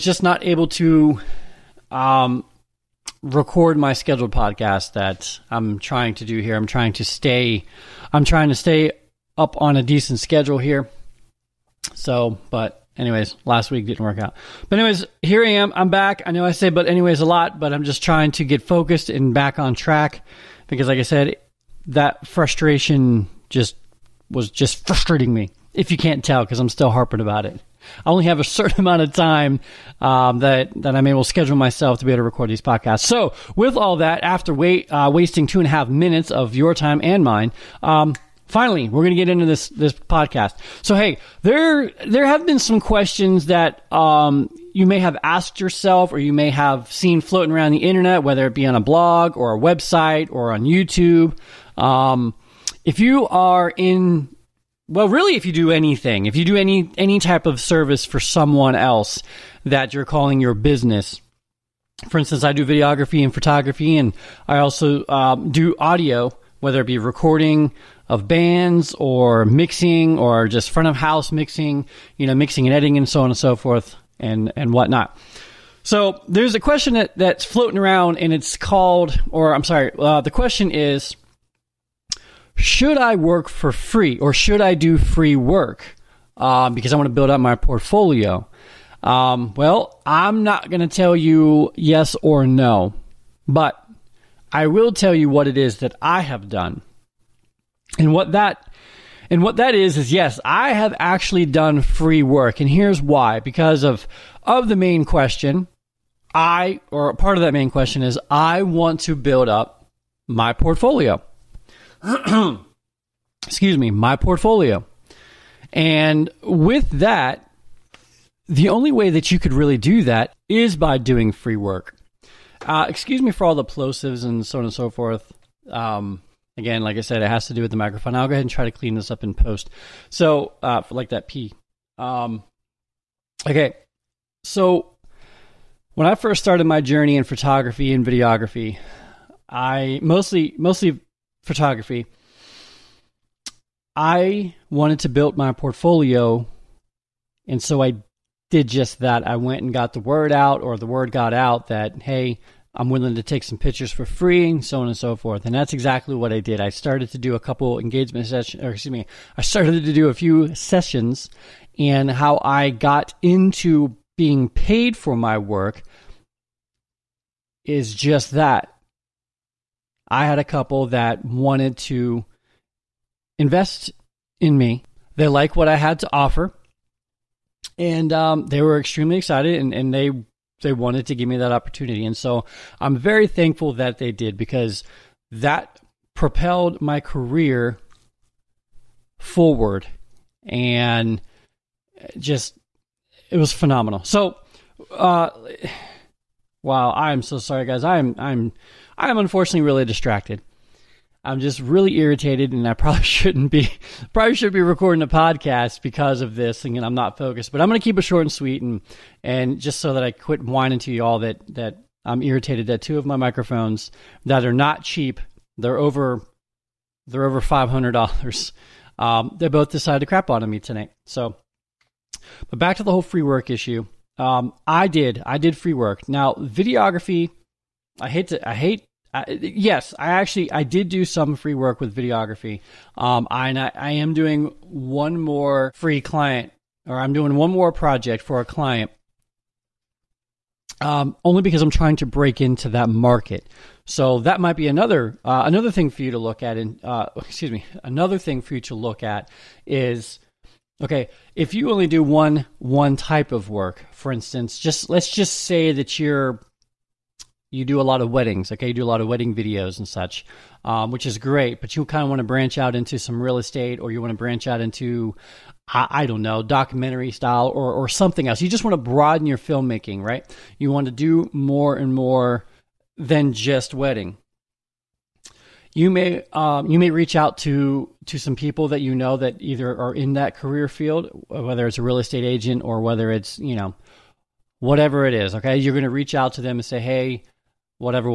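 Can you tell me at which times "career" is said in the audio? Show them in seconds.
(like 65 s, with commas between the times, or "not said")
186 s, 280 s.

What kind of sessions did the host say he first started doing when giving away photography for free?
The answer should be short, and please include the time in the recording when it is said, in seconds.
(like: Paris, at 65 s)
Engagement sessions, at 157 s.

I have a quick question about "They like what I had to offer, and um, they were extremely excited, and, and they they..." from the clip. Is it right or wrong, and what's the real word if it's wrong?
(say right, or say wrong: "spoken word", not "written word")
right.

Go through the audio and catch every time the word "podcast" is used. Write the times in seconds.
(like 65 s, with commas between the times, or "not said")
4 s, 32 s, 39 s, 205 s.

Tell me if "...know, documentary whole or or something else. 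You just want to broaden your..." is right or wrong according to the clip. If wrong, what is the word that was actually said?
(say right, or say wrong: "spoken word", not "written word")
wrong: "style", not "whole".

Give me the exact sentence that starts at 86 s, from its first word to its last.
Uh, because I want to build up my portfolio.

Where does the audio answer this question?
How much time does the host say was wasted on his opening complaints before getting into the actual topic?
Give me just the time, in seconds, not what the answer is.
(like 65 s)
35 s.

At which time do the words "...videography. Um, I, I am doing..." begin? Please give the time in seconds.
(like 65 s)
231 s.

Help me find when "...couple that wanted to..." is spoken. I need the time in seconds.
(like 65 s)
170 s.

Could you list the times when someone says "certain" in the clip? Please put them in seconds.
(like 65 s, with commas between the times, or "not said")
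28 s.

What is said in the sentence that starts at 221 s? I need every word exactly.
So, but back to the whole free work issue.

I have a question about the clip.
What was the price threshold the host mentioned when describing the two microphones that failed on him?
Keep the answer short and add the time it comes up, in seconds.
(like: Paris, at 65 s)
Over $500, at 217 s.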